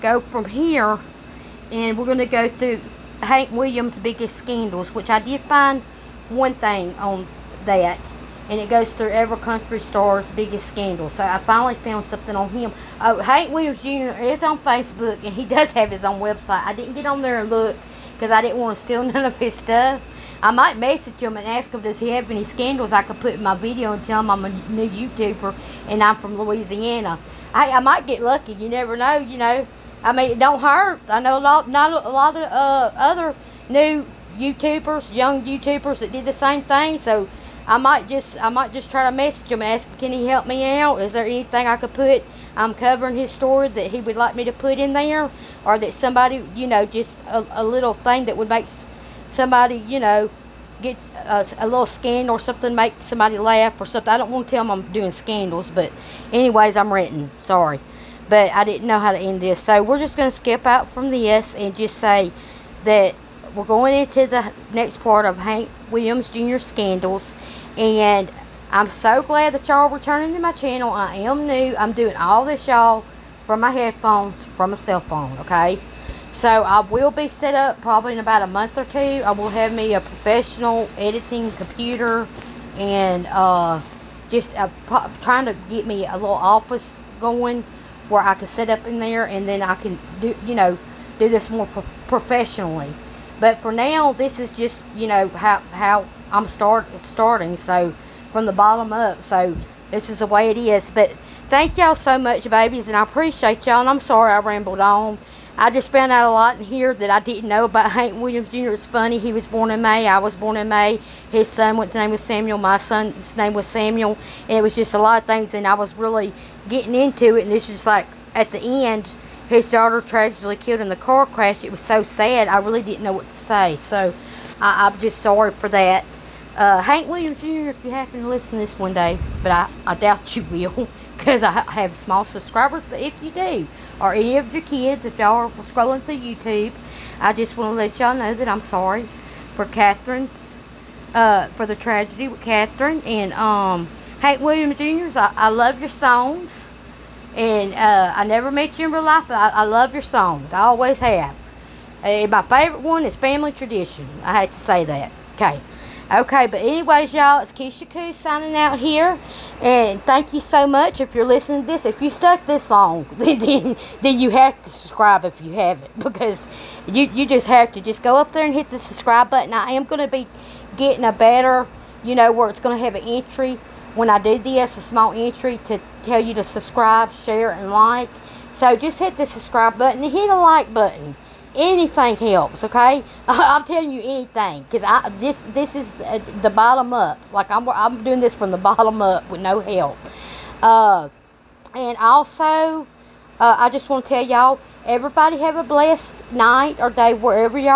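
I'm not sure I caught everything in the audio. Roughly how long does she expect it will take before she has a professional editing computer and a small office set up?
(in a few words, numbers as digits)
A month or two.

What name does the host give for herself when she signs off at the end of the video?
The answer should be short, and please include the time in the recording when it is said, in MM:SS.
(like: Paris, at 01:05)
Kiesha Koo, at 02:37.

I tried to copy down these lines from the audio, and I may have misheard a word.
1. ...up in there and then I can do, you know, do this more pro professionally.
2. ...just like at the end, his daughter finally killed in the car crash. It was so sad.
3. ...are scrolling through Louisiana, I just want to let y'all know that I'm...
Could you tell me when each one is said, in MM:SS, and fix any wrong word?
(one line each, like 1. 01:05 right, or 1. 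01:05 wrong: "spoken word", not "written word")
1. 01:28 right
2. 01:57 wrong: "tragically", not "finally"
3. 02:15 wrong: "YouTube", not "Louisiana".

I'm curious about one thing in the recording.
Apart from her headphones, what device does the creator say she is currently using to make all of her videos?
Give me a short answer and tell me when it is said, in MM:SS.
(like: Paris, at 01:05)
Cell phone, at 01:14.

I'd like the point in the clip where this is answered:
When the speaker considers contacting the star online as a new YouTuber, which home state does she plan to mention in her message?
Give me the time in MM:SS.
00:26.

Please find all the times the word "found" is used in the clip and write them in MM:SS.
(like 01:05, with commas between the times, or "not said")
00:11, 01:45.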